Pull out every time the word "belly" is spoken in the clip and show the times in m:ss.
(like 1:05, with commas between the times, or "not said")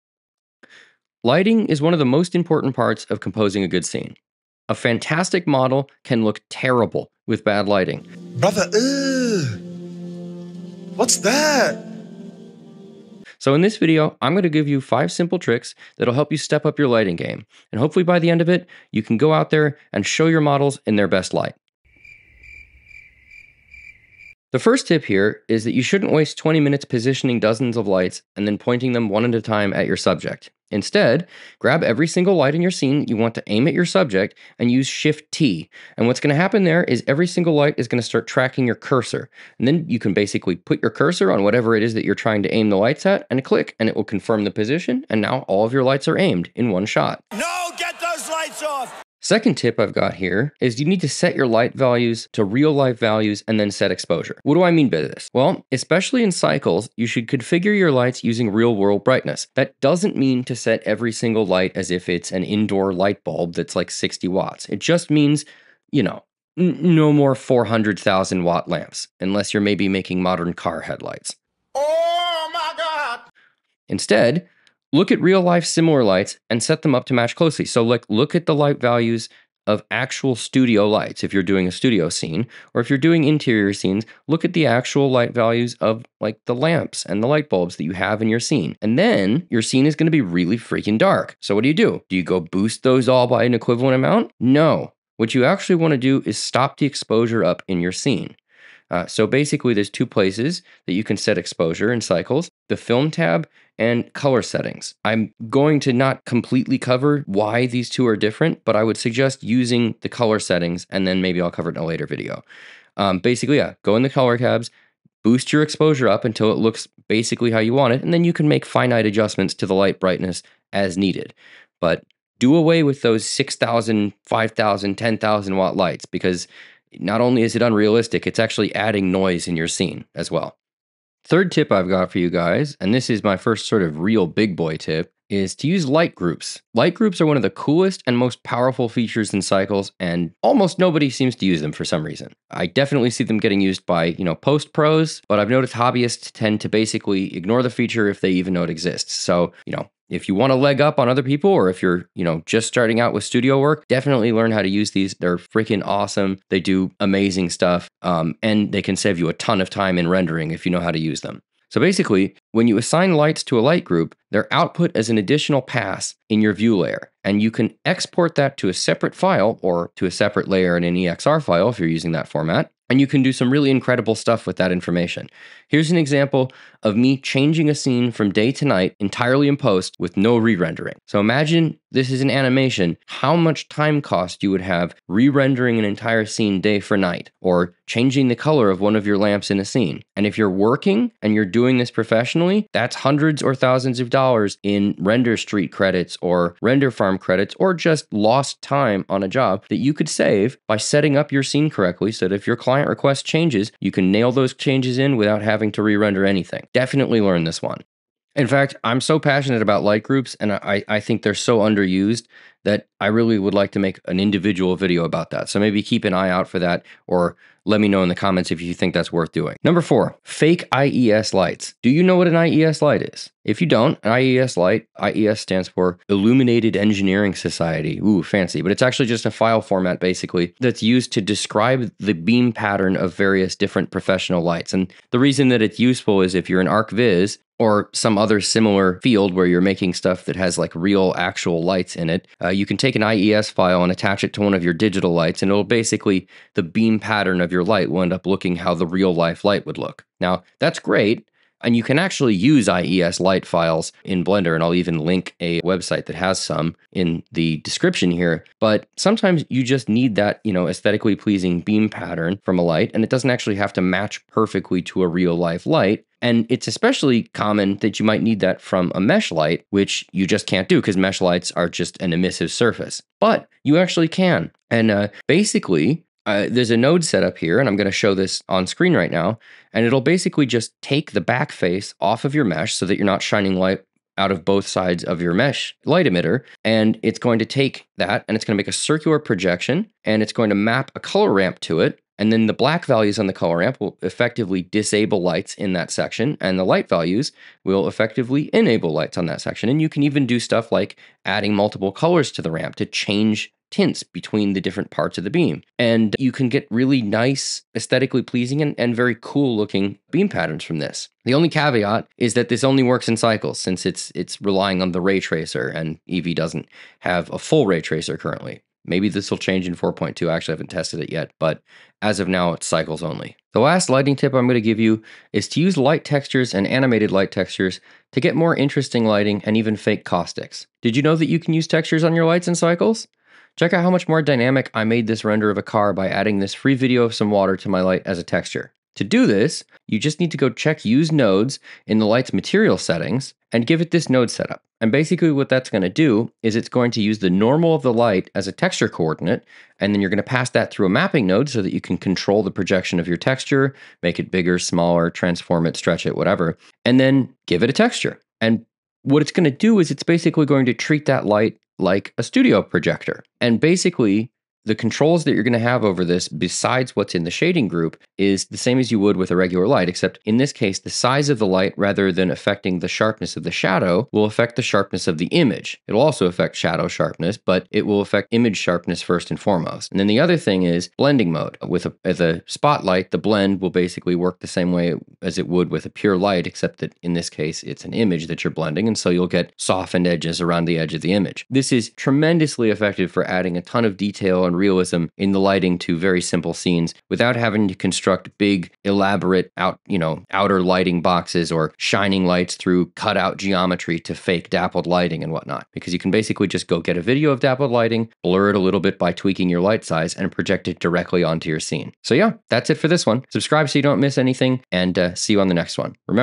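not said.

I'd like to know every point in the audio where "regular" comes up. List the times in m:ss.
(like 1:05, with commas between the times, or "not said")
6:09.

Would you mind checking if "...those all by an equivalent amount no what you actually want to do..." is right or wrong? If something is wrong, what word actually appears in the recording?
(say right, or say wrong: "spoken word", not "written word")
right.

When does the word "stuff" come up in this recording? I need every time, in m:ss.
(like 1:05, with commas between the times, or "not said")
2:37, 2:54, 3:59, 5:00.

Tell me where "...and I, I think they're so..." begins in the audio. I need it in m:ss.
3:30.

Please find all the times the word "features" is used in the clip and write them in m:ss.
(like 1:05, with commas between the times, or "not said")
2:18, 2:27.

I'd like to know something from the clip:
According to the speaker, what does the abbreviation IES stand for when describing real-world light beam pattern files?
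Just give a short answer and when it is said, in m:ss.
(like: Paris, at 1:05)
Illuminated Engineering Society, at 3:46.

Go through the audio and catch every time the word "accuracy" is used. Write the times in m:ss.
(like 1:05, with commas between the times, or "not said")
not said.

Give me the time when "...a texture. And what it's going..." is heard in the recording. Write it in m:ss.
5:57.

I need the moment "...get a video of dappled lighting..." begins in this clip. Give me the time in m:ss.
6:46.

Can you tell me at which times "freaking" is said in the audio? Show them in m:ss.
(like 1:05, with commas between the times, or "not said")
1:30, 2:35.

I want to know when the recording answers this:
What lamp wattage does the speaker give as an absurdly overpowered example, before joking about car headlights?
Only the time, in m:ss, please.
1:07.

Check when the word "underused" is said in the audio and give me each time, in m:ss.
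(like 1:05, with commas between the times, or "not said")
3:31.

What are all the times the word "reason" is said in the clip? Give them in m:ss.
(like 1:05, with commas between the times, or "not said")
2:22, 3:55.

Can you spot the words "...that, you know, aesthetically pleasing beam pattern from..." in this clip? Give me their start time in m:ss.
4:20.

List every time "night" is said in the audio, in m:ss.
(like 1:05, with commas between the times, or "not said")
2:58, 3:06.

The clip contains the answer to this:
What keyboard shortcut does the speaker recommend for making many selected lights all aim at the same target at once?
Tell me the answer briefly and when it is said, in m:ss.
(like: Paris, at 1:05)
Shift T, at 0:34.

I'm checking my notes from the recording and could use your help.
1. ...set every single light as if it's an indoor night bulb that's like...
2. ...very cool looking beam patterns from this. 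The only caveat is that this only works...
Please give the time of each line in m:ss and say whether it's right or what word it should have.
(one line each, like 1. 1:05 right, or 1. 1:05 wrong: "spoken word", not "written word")
1. 1:00 wrong: "light", not "night"
2. 5:08 right.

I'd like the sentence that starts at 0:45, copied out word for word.
And now all of your lights are aimed in one shot.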